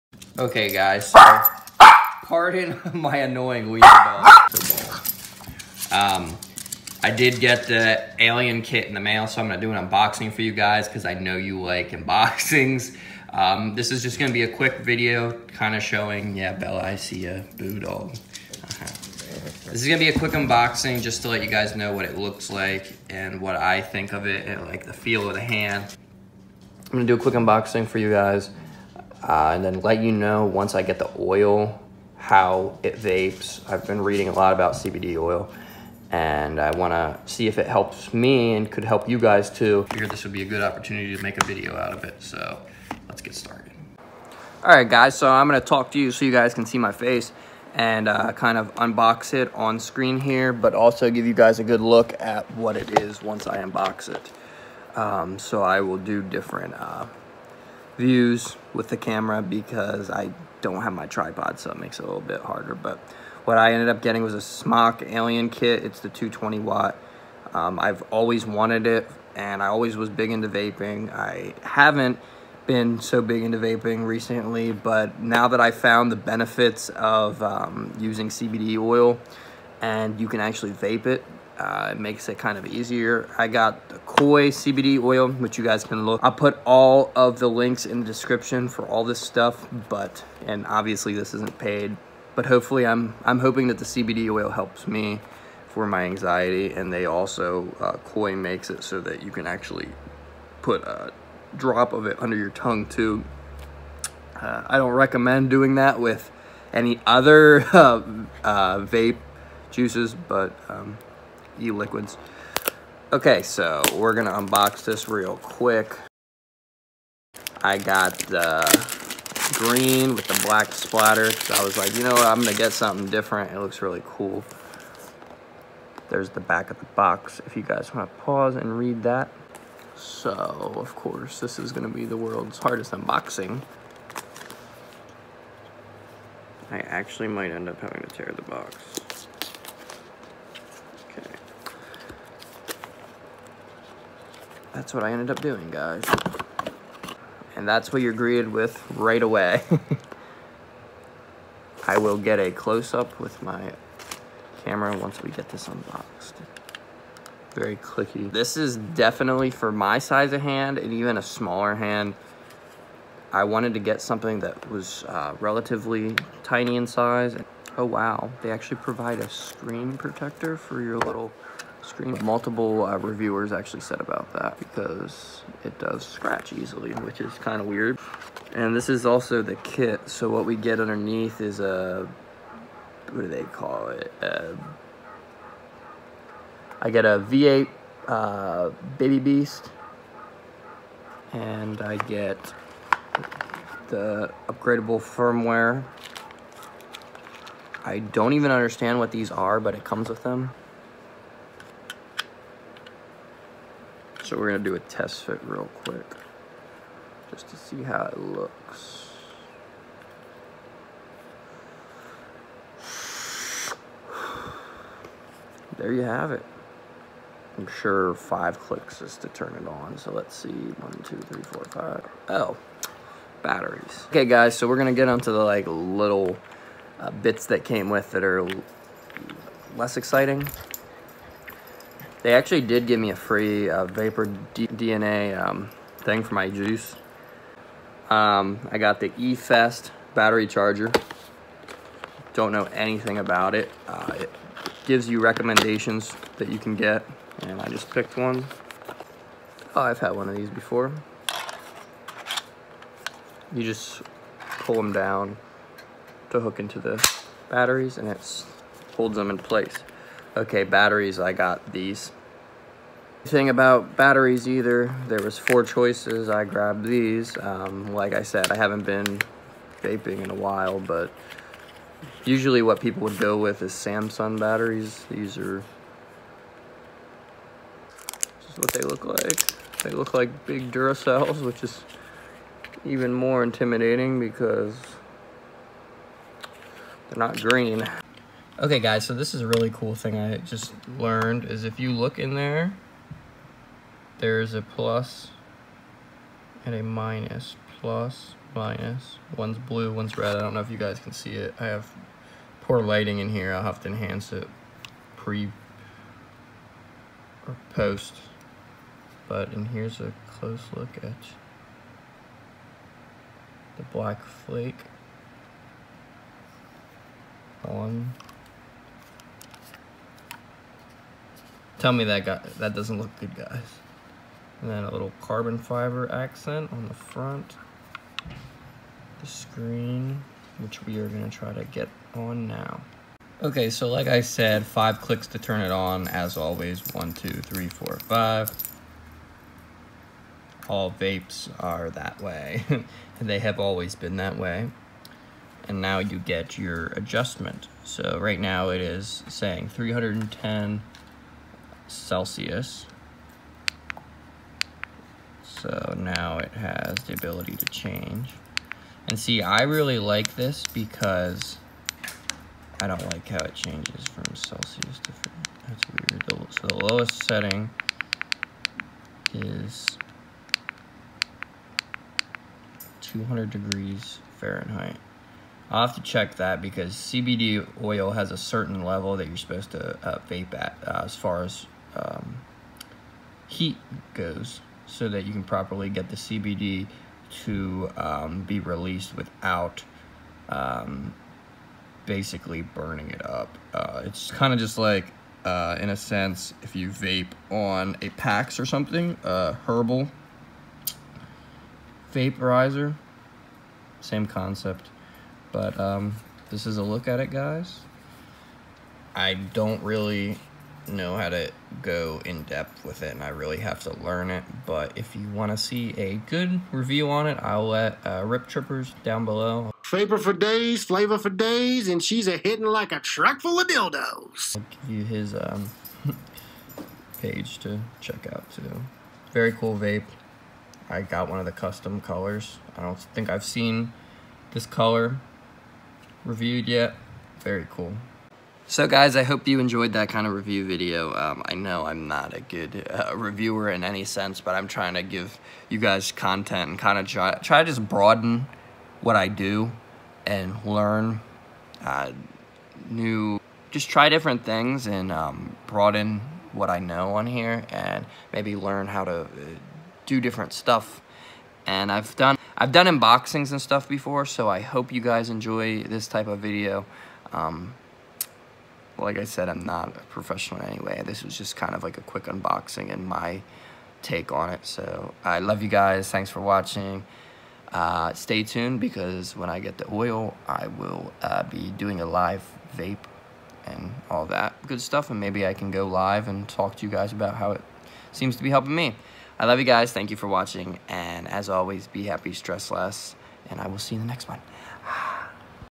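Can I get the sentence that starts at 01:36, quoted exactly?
And they also, uh, Koi makes it so that you can actually put a drop of it under your tongue too.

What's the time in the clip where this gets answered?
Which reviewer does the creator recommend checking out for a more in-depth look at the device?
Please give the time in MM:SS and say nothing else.
06:58.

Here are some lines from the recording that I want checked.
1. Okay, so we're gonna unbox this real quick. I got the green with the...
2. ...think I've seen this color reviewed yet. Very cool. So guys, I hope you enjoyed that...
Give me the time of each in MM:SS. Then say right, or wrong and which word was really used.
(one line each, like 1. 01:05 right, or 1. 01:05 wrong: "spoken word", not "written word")
1. 01:53 right
2. 07:12 right.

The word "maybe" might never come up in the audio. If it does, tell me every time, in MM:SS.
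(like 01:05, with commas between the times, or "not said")
07:38, 08:05.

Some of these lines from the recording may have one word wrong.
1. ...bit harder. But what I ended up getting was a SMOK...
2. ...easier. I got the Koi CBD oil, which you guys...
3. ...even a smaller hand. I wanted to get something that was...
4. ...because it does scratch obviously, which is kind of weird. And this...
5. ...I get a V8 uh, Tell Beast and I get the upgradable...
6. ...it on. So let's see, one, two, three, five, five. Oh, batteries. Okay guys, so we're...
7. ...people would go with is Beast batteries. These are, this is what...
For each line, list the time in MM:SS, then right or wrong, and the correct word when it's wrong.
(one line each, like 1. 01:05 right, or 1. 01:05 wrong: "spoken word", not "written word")
1. 01:02 right
2. 01:22 right
3. 02:40 right
4. 02:54 wrong: "easily", not "obviously"
5. 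03:06 wrong: "Baby", not "Tell"
6. 03:39 wrong: "four", not "five"
7. 04:32 wrong: "Samsung", not "Beast".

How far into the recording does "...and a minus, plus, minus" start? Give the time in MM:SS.
04:56.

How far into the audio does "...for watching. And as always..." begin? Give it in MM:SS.
08:10.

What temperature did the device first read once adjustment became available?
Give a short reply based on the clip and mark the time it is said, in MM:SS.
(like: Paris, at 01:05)
310 Celsius, at 05:49.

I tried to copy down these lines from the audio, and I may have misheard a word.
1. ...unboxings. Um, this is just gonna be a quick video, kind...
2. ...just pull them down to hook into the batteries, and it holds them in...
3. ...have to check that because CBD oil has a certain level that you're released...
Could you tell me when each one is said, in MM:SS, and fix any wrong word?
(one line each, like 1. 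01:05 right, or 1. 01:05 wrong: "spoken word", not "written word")
1. 00:11 right
2. 04:13 right
3. 06:15 wrong: "supposed", not "released".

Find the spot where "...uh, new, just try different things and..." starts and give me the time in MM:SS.
07:31.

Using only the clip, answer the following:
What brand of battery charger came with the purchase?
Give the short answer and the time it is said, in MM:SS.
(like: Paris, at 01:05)
E-Fest, at 03:59.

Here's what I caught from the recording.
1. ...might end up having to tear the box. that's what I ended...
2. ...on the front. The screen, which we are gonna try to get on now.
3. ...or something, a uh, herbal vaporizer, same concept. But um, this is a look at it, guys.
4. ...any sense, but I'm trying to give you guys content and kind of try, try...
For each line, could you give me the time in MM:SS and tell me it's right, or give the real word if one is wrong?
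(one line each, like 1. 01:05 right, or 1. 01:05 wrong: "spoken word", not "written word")
1. 02:17 right
2. 05:26 right
3. 06:38 right
4. 07:23 right.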